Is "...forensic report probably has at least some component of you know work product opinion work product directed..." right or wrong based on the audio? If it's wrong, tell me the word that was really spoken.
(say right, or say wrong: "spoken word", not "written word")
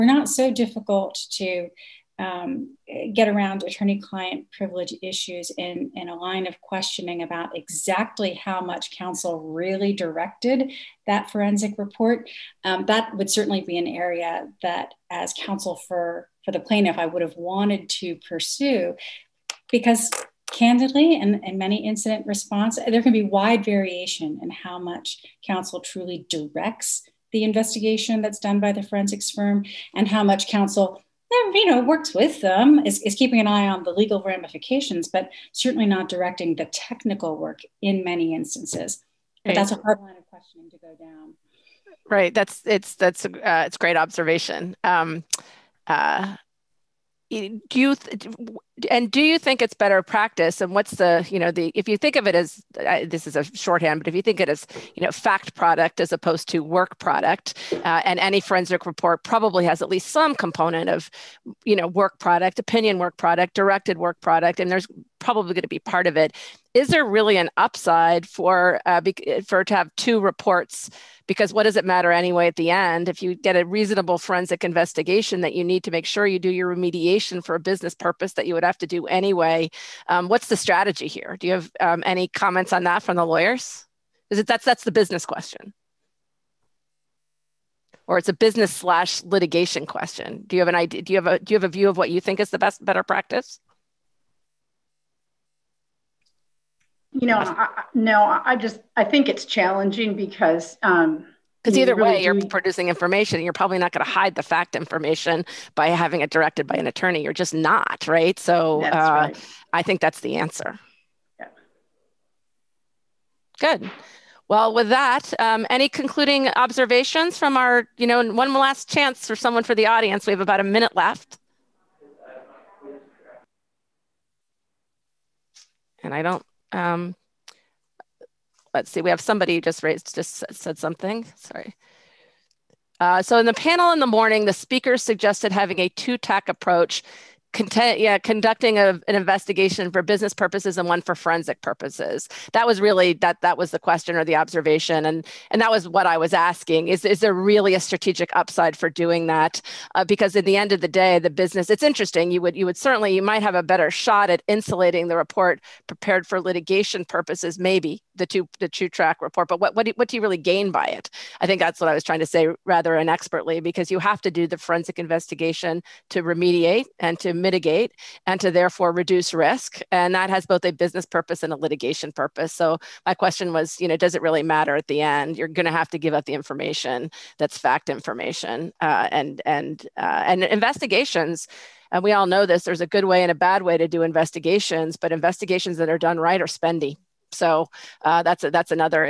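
right.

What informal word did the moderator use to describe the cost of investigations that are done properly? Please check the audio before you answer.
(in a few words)
spendy.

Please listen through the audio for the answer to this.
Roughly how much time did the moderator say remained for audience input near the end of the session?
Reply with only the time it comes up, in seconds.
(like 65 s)
120 s.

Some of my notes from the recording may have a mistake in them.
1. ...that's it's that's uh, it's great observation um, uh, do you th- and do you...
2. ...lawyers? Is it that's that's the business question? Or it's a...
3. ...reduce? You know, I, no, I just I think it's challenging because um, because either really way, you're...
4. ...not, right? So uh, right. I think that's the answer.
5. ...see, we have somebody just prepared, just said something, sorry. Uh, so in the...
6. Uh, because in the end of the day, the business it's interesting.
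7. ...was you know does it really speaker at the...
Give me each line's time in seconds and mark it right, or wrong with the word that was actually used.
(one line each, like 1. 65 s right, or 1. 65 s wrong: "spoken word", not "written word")
1. 42 s right
2. 83 s right
3. 93 s wrong: "practice", not "reduce"
4. 107 s right
5. 128 s wrong: "raised", not "prepared"
6. 149 s right
7. 173 s wrong: "matter", not "speaker".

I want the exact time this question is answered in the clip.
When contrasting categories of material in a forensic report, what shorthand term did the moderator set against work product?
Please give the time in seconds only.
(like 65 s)
55 s.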